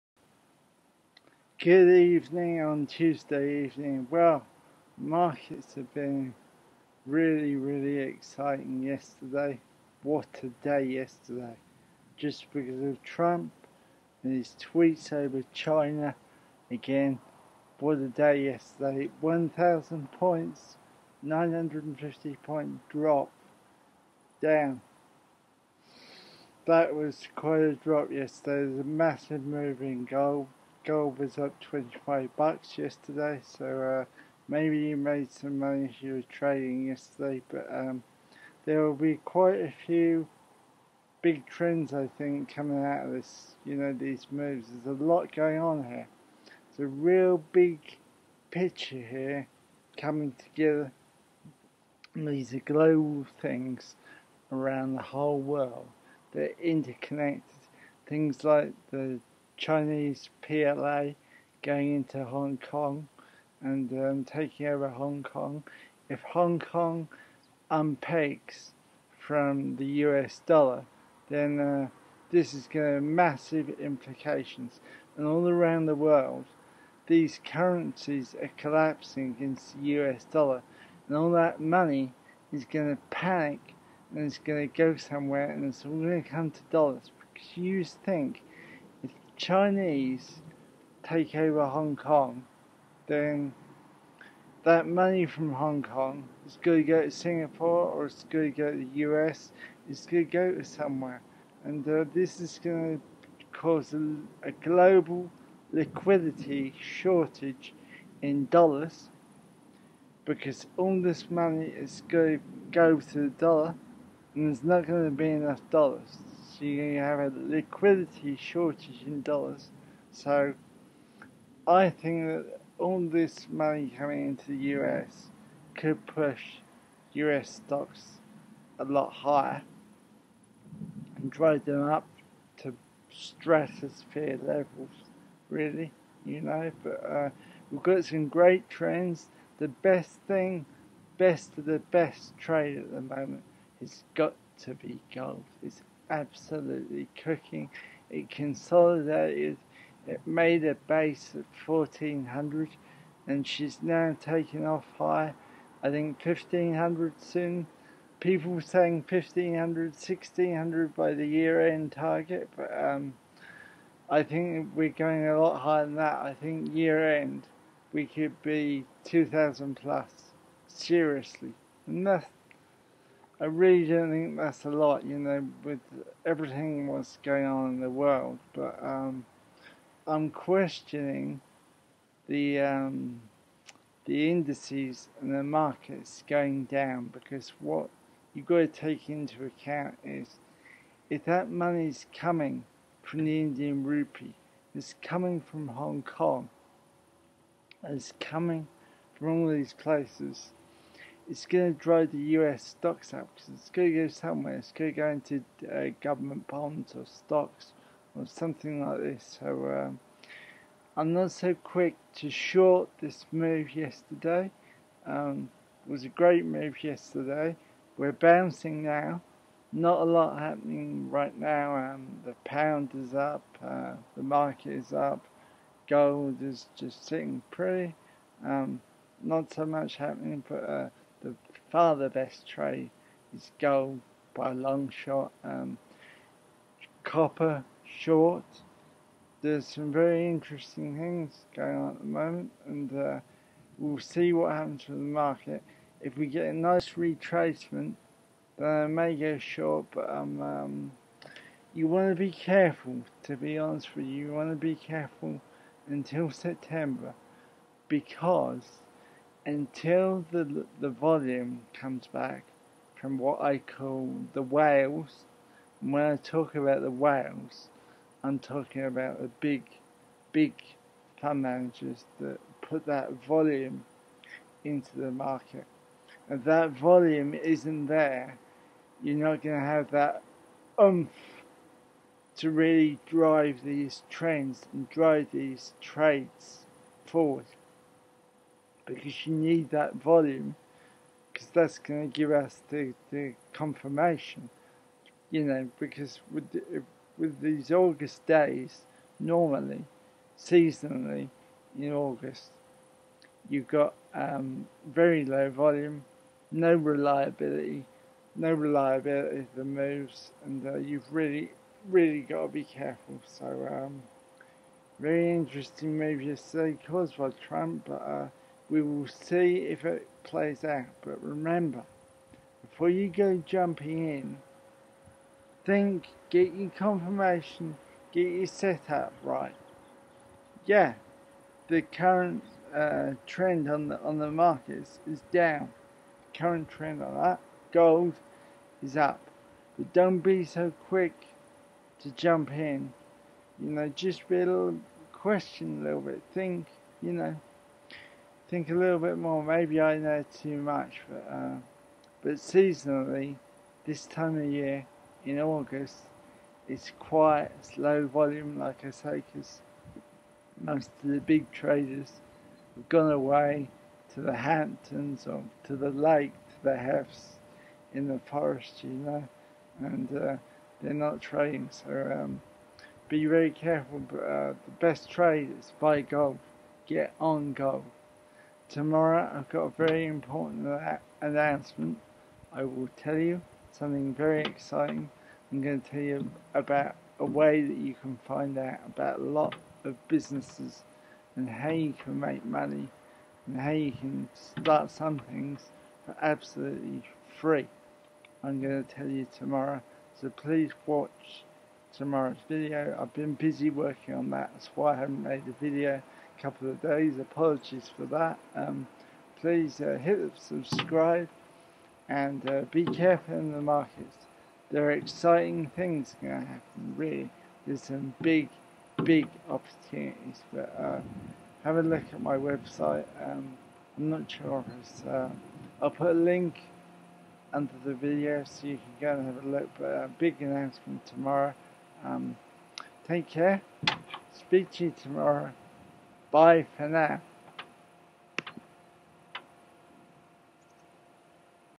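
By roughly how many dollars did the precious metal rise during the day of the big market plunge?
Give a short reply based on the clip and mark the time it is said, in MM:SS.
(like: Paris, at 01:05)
25, at 00:31.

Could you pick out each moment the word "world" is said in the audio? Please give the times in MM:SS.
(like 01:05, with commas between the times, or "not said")
00:55, 01:15, 02:57.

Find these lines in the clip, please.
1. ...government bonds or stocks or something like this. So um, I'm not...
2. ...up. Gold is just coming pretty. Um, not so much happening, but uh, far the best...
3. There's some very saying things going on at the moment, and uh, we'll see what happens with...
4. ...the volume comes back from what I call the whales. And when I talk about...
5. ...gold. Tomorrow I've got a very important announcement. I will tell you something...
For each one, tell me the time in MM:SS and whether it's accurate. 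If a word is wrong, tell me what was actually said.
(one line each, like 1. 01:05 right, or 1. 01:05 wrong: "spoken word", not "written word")
1. 03:26 right
2. 03:44 wrong: "sitting", not "coming"
3. 03:59 wrong: "interesting", not "saying"
4. 04:20 right
5. 06:17 right.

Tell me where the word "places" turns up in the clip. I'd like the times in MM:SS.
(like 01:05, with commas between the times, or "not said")
03:19.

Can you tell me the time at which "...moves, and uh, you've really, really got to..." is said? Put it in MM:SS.
05:09.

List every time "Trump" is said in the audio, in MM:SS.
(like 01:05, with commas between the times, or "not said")
00:13, 05:17.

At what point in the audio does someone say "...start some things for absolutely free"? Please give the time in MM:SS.
06:34.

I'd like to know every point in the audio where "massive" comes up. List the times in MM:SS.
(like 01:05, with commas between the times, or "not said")
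00:28, 01:13.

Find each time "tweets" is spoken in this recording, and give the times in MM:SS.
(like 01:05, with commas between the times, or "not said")
00:14.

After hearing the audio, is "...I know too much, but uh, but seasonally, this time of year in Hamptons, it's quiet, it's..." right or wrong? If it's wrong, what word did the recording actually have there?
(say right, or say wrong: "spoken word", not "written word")
wrong: "August", not "Hamptons".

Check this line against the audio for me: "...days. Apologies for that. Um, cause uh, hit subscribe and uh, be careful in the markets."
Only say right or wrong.
wrong.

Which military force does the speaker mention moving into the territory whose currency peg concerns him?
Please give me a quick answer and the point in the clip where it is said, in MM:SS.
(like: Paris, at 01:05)
PLA, at 01:00.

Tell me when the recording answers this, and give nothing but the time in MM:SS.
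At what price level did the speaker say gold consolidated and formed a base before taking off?
02:31.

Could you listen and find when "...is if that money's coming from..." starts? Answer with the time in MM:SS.
03:10.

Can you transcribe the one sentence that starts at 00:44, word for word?
There's a lot going on here.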